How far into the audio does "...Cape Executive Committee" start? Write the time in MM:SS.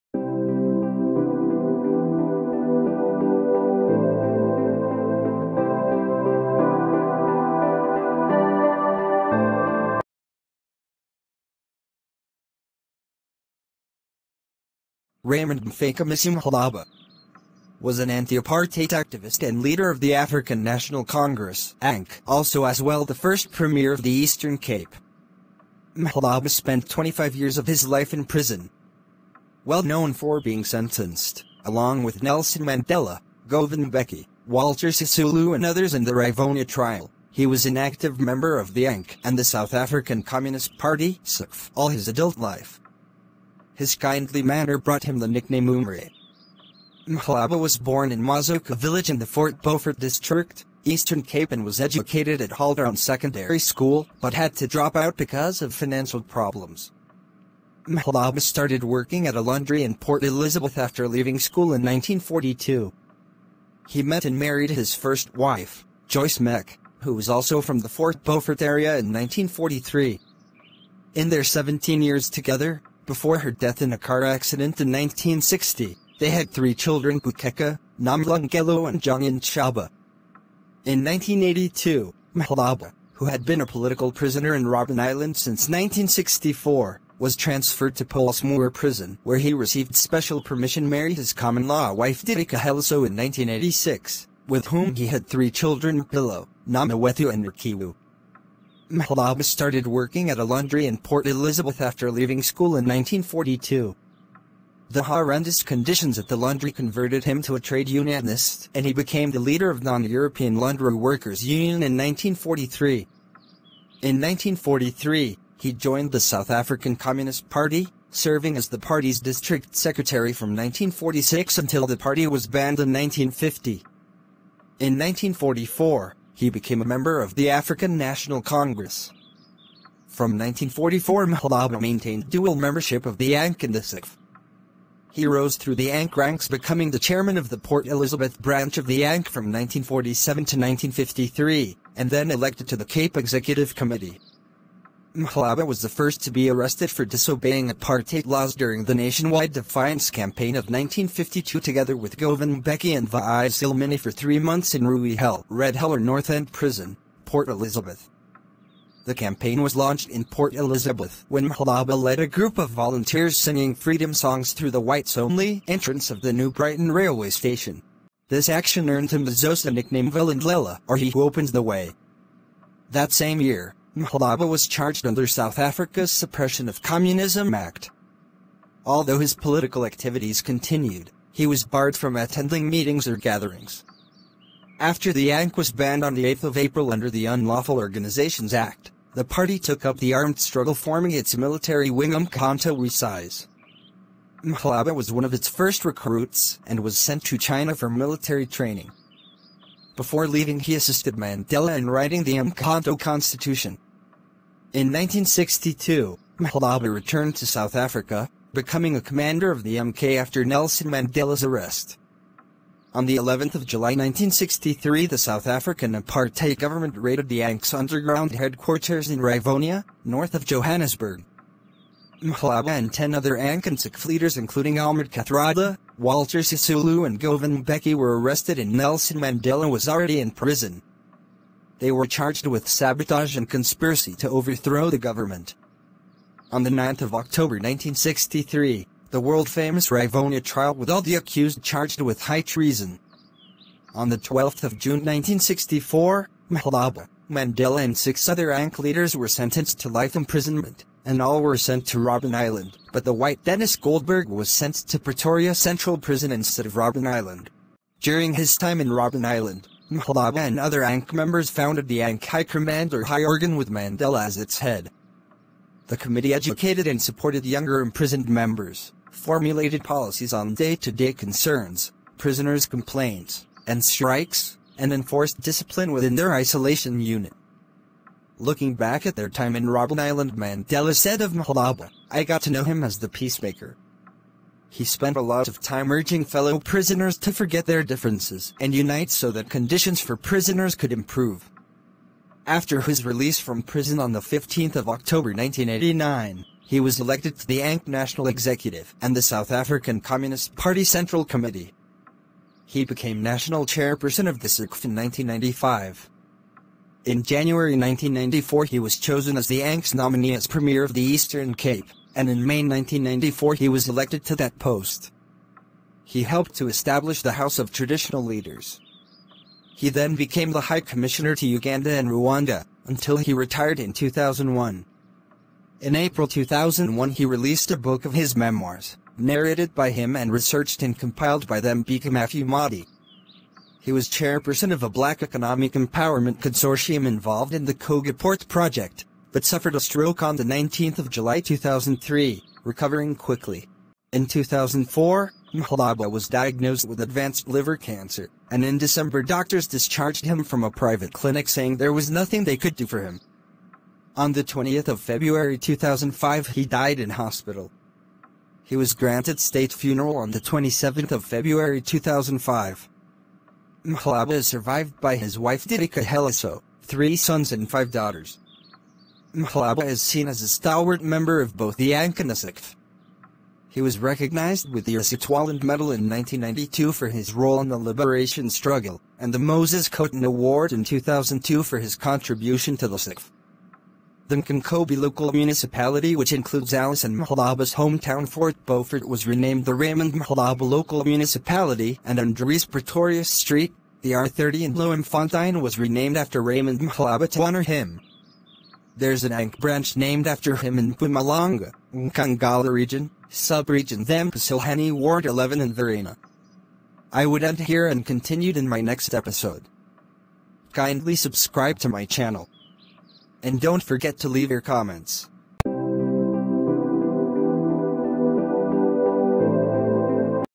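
02:22.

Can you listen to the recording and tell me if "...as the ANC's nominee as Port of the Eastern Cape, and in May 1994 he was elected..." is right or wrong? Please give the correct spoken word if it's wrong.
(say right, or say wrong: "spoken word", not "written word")
wrong: "Premier", not "Port".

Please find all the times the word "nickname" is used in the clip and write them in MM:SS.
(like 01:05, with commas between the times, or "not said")
00:45, 02:49.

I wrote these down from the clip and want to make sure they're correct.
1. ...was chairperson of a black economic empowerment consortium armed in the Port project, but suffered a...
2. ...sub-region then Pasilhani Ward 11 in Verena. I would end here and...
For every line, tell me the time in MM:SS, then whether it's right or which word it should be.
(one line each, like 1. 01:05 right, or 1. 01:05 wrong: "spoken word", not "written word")
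1. 05:33 wrong: "involved", not "armed"
2. 06:43 right.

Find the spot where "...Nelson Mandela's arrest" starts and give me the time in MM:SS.
03:30.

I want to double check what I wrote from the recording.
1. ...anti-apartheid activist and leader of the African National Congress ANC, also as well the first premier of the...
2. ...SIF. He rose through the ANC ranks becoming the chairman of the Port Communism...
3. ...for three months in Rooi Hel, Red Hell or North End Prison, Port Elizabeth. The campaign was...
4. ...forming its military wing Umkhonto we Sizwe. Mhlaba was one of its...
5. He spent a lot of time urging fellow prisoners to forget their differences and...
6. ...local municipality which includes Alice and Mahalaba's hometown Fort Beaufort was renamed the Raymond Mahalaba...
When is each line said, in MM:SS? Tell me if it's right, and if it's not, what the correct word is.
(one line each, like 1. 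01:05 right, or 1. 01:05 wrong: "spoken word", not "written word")
1. 00:18 right
2. 02:13 wrong: "Elizabeth", not "Communism"
3. 02:33 right
4. 03:10 right
5. 04:44 right
6. 06:24 right.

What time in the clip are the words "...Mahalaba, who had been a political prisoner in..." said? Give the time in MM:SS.
01:22.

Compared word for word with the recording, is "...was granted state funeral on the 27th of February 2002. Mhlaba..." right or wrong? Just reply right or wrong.
wrong.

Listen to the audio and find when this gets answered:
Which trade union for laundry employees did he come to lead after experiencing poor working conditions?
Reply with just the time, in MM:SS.
01:49.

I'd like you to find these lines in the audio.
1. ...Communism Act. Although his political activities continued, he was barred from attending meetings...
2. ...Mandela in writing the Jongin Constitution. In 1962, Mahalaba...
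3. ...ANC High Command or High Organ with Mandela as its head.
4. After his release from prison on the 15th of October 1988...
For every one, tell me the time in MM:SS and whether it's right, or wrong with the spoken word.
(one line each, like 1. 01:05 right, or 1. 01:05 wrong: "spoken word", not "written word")
1. 02:56 right
2. 03:21 wrong: "Mkanto", not "Jongin"
3. 04:22 right
4. 04:52 wrong: "1989", not "1988".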